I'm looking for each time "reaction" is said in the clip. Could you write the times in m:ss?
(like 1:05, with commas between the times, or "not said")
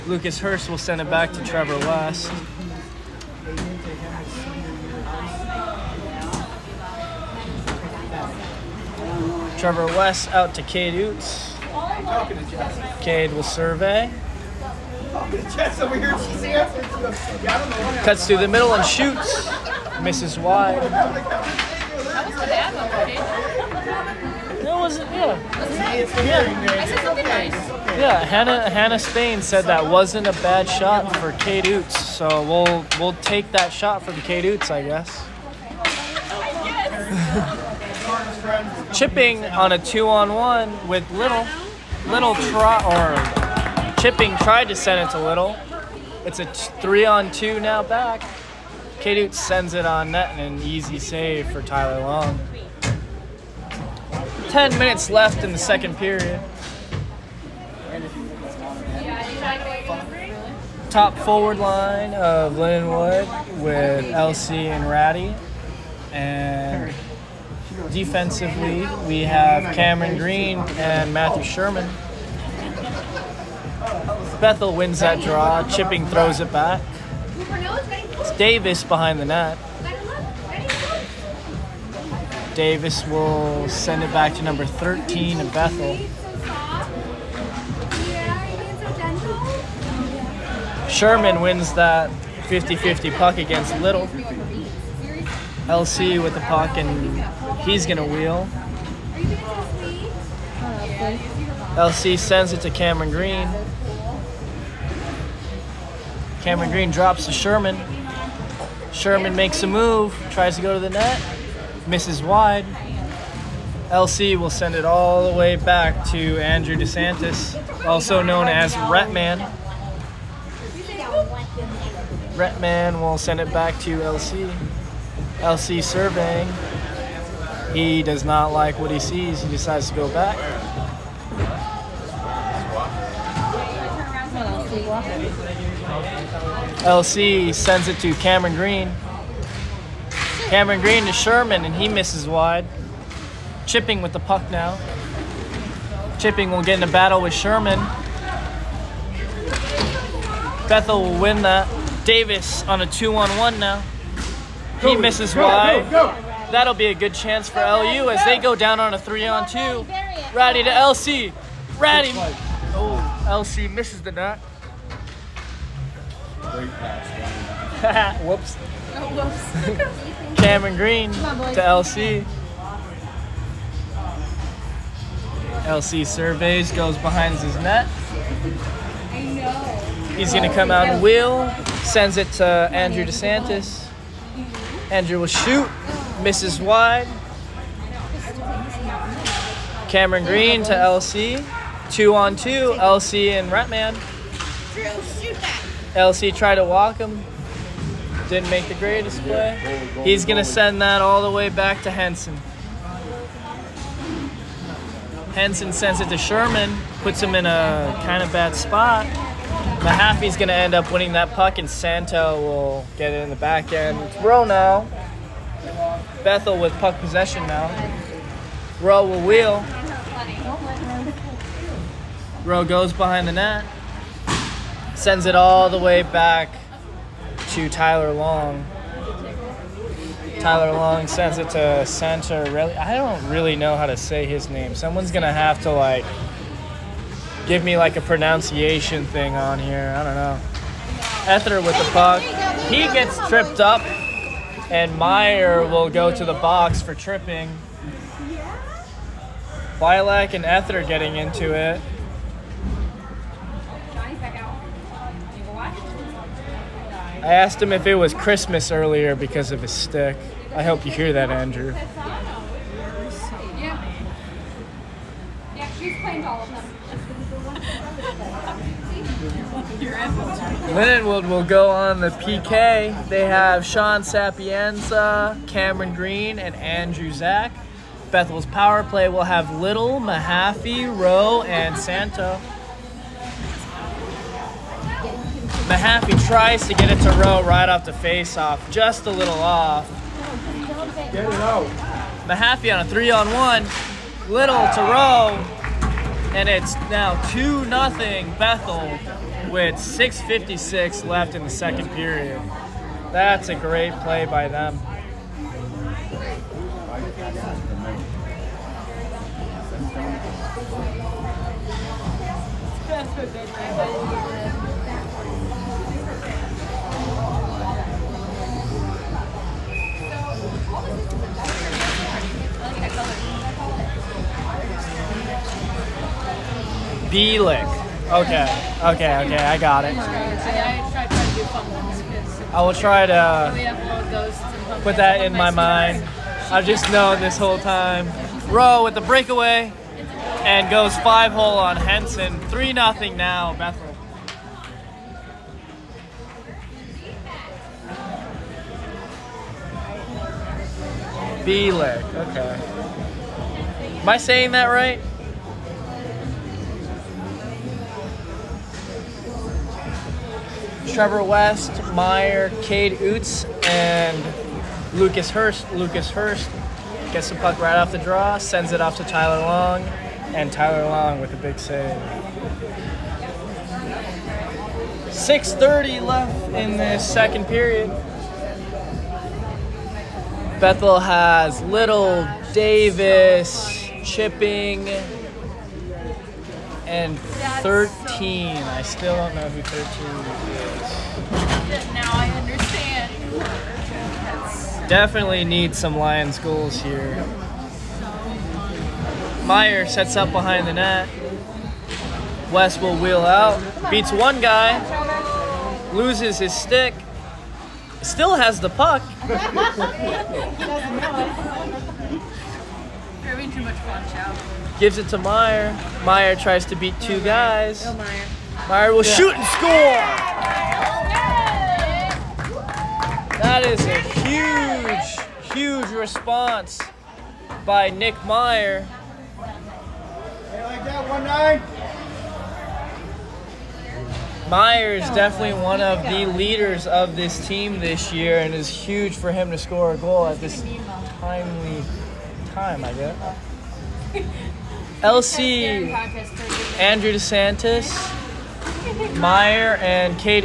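not said.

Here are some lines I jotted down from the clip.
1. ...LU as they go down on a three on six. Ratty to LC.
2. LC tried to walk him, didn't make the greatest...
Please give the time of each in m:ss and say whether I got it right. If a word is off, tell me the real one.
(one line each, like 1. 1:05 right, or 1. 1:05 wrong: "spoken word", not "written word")
1. 2:37 wrong: "two", not "six"
2. 3:15 right.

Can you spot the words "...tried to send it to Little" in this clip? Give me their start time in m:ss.
0:44.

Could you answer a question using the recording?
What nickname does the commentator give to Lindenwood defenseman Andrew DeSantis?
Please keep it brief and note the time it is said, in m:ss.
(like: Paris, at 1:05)
Ret Man, at 1:58.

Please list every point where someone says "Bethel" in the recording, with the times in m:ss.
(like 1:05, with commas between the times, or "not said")
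1:14, 1:25, 2:30, 3:36, 4:38, 4:58, 5:43, 6:20.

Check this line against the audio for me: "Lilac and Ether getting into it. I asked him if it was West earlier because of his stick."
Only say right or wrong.
wrong.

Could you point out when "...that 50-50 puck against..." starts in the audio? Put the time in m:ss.
1:31.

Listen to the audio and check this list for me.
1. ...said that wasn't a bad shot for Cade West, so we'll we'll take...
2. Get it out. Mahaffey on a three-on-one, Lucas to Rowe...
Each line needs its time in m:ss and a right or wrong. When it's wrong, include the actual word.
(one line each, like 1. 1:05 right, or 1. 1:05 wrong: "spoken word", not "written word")
1. 0:29 wrong: "Oots", not "West"
2. 4:51 wrong: "Little", not "Lucas".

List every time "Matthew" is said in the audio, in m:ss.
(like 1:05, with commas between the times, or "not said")
1:11.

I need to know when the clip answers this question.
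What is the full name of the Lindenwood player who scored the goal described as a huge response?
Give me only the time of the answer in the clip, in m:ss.
7:07.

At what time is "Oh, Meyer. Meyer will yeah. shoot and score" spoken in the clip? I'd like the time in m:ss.
6:57.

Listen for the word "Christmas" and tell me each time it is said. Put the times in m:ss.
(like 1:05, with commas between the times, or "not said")
4:18.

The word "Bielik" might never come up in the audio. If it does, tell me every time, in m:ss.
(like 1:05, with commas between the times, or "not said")
5:27.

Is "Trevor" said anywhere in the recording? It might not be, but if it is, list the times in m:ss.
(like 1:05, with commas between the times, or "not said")
0:01, 0:09, 6:00.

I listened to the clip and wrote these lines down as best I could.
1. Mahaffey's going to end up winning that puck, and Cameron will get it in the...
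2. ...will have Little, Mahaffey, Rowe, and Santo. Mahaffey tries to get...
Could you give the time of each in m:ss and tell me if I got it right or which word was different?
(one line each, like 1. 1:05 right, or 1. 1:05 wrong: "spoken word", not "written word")
1. 3:29 wrong: "Santo", not "Cameron"
2. 4:39 right.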